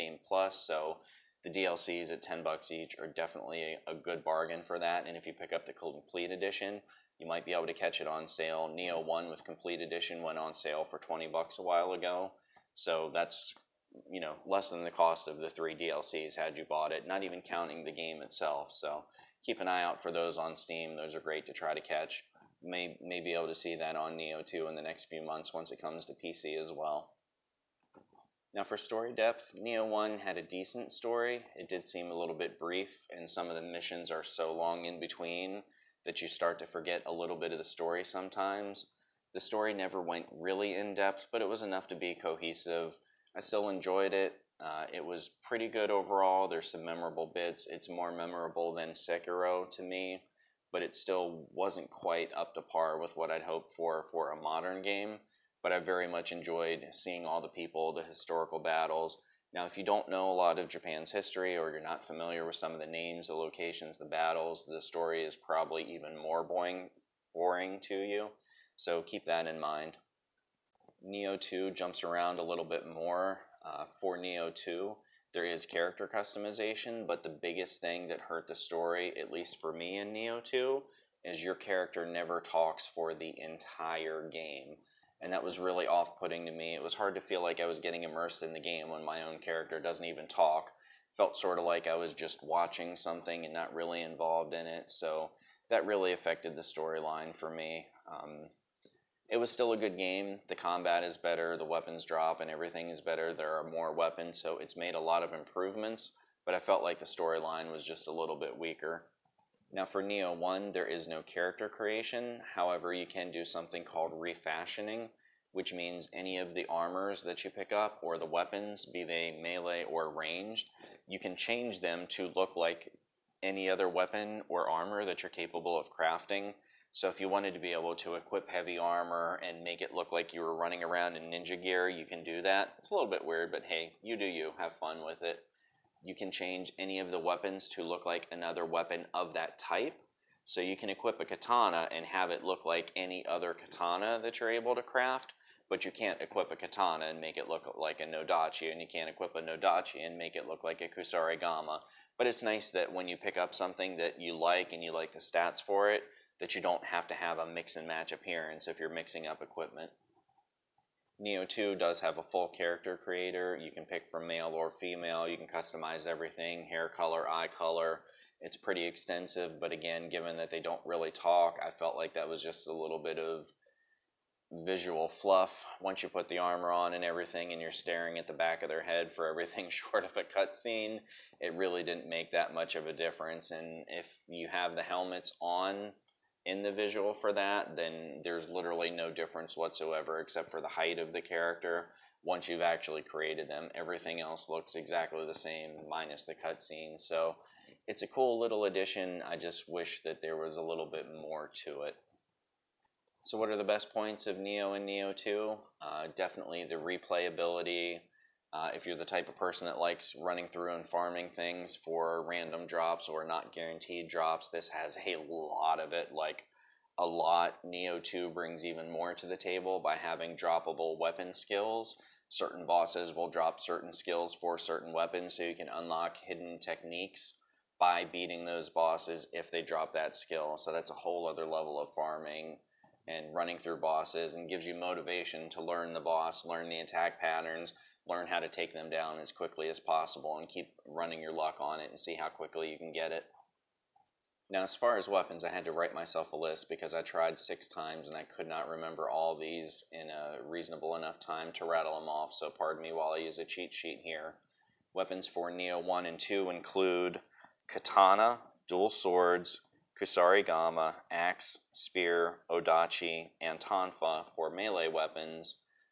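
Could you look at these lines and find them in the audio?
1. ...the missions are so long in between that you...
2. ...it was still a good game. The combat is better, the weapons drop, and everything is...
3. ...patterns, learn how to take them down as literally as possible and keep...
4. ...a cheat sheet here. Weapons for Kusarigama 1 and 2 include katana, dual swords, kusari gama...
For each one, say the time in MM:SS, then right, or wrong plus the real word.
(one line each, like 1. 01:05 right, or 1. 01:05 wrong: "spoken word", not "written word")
1. 00:33 right
2. 01:39 right
3. 03:57 wrong: "quickly", not "literally"
4. 04:13 wrong: "Nioh", not "Kusarigama".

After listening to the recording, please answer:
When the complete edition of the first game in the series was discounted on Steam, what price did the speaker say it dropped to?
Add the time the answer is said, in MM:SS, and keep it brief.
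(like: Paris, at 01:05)
$20, at 00:10.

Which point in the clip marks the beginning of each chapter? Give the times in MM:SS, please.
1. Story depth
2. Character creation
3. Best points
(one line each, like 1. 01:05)
1. 00:27
2. 01:49
3. 03:22.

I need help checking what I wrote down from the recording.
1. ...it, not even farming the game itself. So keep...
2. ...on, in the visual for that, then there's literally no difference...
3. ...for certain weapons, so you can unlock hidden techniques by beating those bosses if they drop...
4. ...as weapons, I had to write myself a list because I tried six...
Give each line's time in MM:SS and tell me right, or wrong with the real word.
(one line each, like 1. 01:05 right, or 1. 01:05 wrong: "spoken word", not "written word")
1. 00:16 wrong: "counting", not "farming"
2. 03:05 right
3. 03:44 right
4. 04:04 right.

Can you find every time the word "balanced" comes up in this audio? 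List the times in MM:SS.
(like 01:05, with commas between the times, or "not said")
not said.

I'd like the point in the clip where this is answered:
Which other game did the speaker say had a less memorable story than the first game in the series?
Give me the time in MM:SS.
00:48.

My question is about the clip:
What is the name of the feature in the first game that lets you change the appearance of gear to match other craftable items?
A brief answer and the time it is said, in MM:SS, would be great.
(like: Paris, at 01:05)
refashioning, at 01:54.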